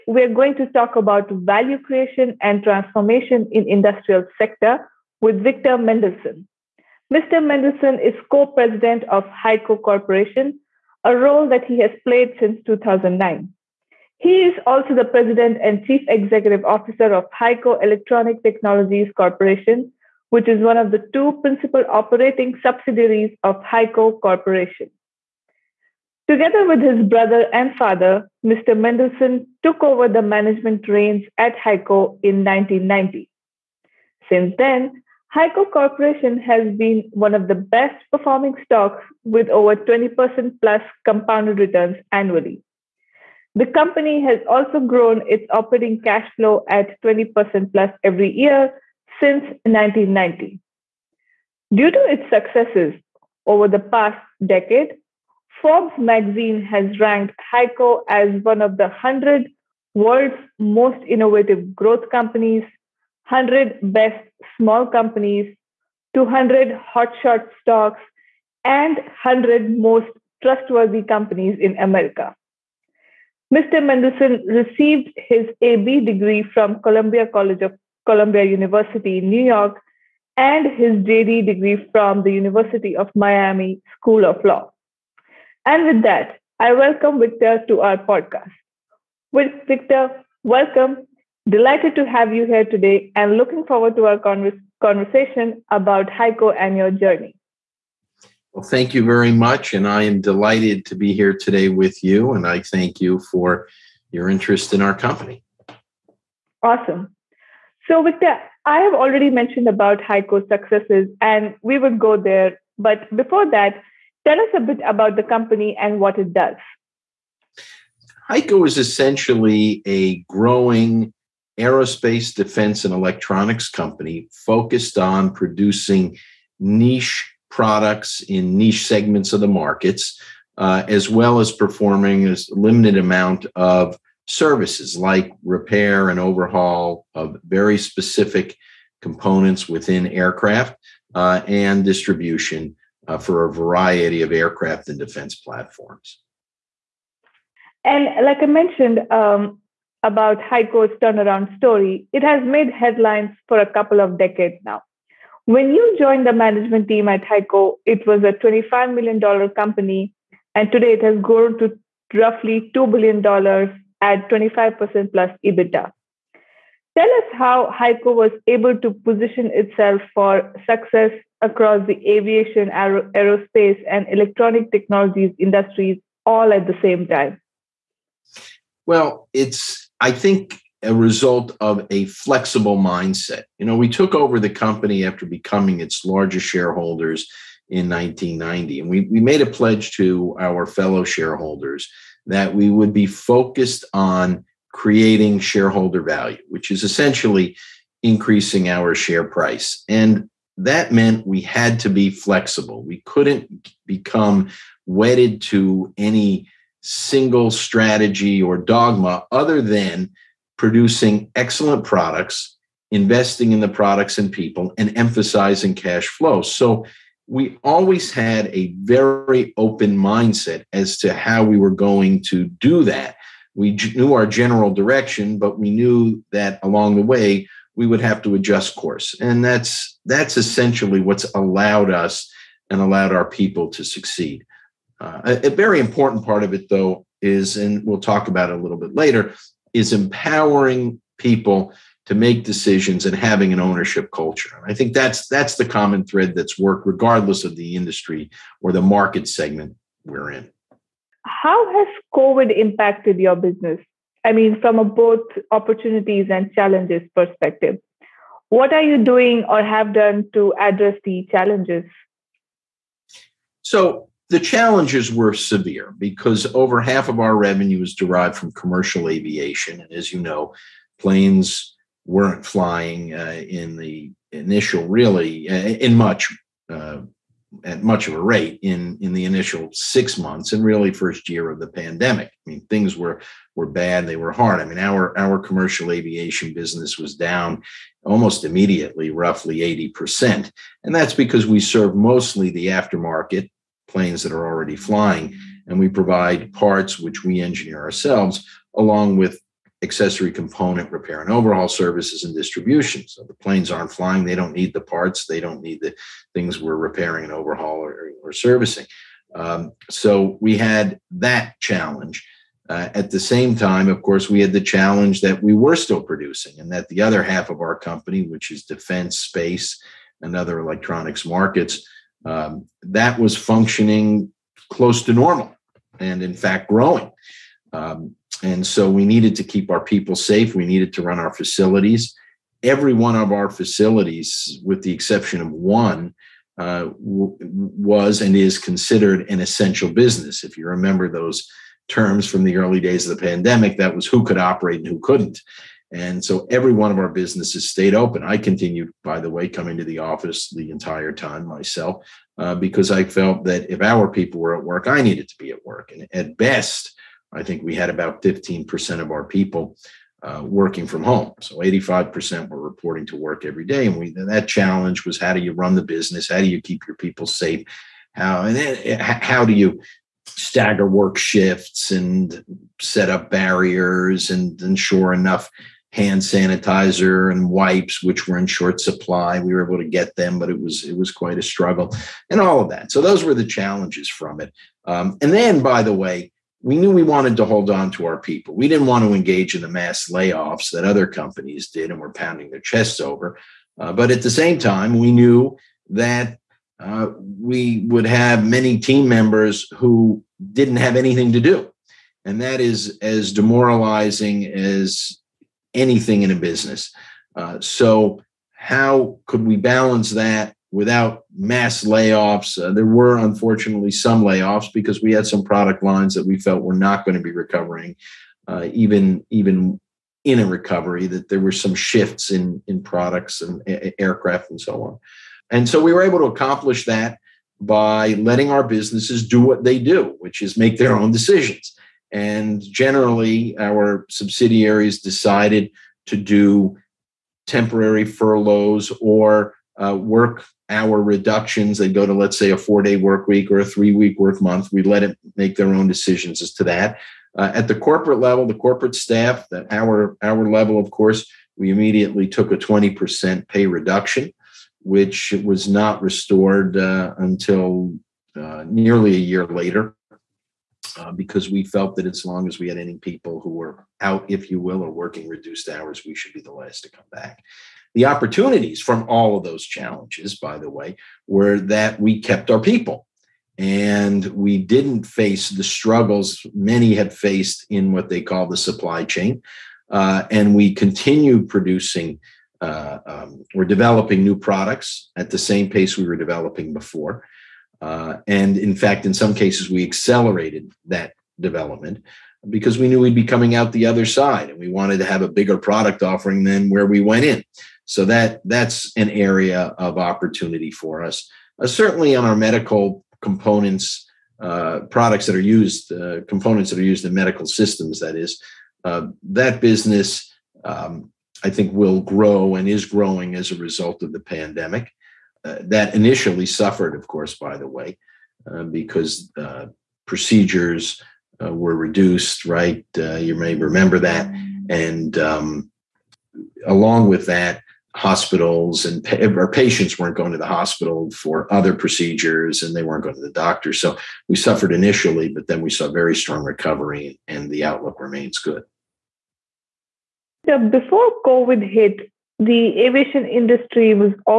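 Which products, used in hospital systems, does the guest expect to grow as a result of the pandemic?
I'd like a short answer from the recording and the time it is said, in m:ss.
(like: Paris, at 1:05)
medical components, at 8:22.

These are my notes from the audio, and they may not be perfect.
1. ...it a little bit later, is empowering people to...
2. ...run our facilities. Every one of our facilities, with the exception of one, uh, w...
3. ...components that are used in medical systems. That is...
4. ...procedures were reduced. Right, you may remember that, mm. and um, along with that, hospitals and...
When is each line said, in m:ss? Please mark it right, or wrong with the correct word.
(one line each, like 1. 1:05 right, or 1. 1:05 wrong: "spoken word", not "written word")
1. 3:58 right
2. 5:31 right
3. 8:26 right
4. 8:40 right.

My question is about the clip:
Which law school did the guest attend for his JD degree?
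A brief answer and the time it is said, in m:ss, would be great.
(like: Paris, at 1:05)
University of Miami School of Law, at 1:22.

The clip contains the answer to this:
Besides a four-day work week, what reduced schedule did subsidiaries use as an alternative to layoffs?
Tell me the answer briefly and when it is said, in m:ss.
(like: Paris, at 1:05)
three week work month, at 7:23.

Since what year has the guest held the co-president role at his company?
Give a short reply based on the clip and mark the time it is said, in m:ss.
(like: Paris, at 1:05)
2009, at 0:12.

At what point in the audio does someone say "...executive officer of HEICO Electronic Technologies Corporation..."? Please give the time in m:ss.
0:16.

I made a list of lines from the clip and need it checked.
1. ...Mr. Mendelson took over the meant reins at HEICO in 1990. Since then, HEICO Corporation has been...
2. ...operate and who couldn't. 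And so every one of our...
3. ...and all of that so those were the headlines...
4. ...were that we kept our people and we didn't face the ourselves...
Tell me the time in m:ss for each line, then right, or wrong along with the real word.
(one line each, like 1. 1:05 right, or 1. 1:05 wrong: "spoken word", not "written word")
1. 0:28 wrong: "management", not "meant"
2. 5:44 right
3. 6:22 wrong: "challenges", not "headlines"
4. 7:51 wrong: "struggles", not "ourselves".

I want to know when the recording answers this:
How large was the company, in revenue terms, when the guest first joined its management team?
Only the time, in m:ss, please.
2:38.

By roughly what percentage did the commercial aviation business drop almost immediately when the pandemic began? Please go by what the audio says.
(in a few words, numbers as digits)
80%.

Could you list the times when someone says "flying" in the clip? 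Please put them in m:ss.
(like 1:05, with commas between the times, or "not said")
4:32, 4:54, 5:03.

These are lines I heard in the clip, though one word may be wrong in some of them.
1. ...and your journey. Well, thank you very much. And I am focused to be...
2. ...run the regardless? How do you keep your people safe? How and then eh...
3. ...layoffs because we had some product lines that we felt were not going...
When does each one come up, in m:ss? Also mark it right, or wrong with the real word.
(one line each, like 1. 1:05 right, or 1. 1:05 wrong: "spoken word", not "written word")
1. 1:36 wrong: "delighted", not "focused"
2. 6:05 wrong: "business", not "regardless"
3. 6:54 right.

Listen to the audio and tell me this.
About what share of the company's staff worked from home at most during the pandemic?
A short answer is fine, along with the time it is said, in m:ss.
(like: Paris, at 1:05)
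15%, at 5:58.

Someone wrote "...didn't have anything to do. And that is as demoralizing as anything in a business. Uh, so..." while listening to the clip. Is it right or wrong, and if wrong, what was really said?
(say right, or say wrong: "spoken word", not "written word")
right.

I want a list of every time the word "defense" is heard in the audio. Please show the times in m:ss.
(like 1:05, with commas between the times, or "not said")
2:02, 2:24, 5:18.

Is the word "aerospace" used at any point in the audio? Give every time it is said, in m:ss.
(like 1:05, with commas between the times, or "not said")
2:01, 2:53.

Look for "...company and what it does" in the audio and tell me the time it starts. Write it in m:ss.
1:55.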